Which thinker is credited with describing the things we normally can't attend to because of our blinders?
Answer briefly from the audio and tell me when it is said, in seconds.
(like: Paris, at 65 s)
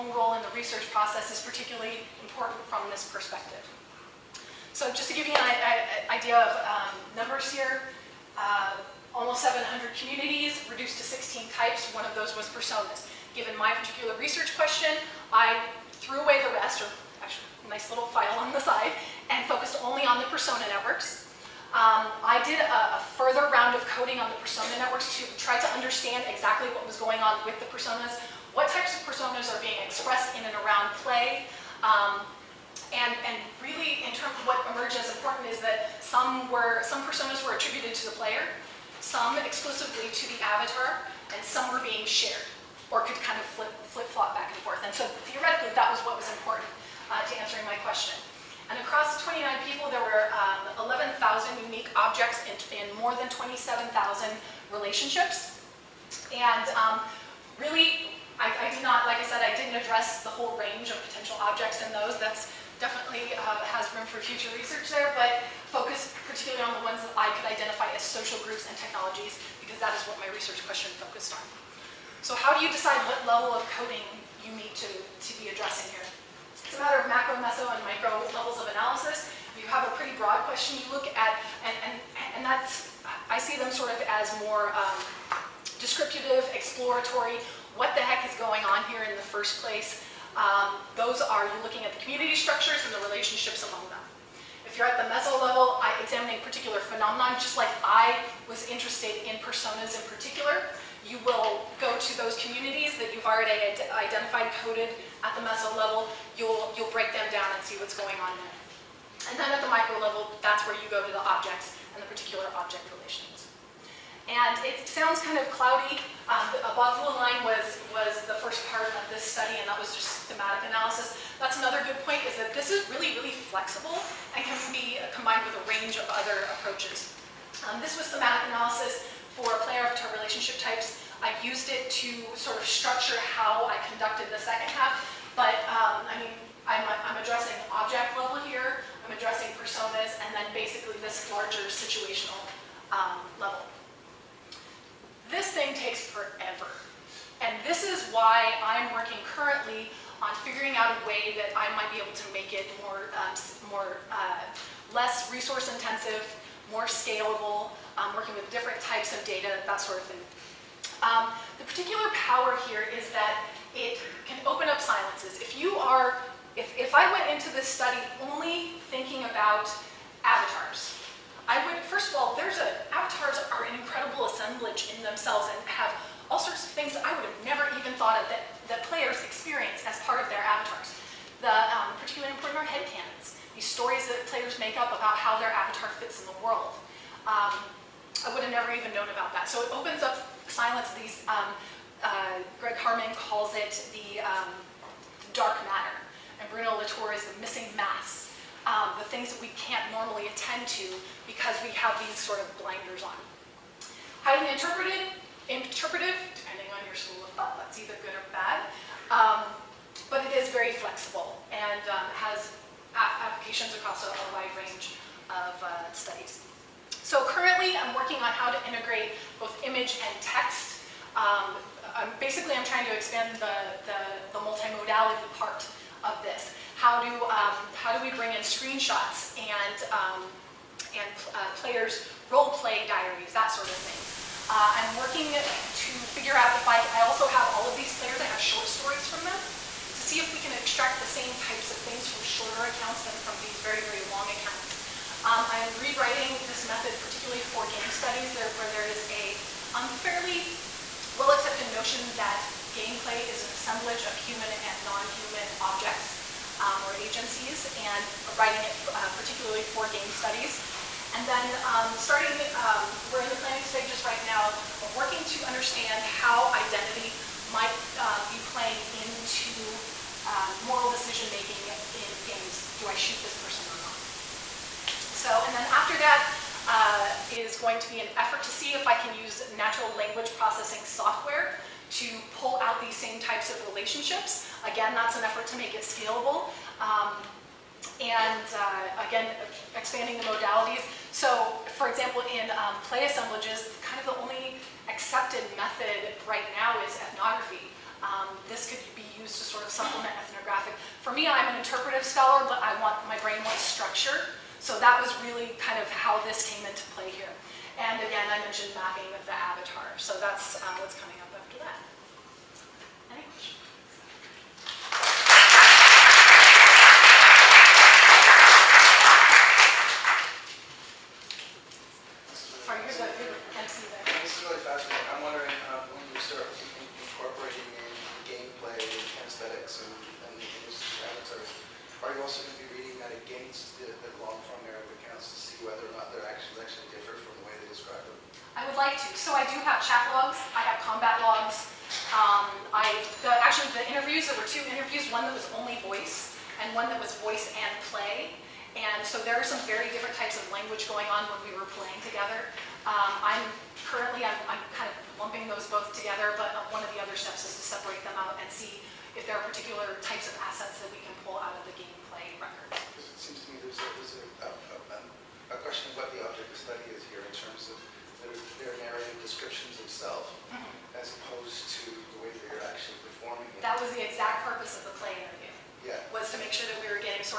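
Graham Harman, at 192 s.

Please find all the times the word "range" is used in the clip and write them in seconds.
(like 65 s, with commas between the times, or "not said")
60 s, 125 s, 214 s.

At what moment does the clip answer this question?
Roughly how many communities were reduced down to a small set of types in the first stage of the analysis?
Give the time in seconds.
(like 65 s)
9 s.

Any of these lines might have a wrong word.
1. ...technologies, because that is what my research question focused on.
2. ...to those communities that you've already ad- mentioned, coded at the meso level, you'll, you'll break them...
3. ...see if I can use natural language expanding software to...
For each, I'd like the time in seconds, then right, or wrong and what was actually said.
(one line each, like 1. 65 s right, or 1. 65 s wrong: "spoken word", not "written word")
1. 68 s right
2. 101 s wrong: "identified", not "mentioned"
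3. 278 s wrong: "processing", not "expanding".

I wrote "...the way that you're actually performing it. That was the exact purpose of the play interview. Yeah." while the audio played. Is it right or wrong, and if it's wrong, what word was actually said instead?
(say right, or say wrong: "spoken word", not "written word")
right.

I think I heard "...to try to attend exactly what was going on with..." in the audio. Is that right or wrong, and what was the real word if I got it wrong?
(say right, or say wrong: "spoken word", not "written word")
wrong: "understand", not "attend".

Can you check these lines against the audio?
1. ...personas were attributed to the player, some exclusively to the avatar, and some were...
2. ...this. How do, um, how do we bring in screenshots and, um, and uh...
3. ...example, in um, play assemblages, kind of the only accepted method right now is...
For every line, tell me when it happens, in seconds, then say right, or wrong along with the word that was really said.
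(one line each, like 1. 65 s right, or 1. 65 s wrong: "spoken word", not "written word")
1. 37 s right
2. 226 s right
3. 291 s right.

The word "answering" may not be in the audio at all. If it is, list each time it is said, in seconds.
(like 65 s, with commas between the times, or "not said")
47 s.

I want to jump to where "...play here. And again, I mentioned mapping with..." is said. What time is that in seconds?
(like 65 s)
306 s.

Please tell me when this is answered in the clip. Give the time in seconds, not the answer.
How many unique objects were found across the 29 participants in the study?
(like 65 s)
50 s.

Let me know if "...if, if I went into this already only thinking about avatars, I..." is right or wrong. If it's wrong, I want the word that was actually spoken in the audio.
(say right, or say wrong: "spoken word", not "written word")
wrong: "study", not "already".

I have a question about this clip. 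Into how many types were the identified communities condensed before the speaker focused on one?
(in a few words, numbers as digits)
16.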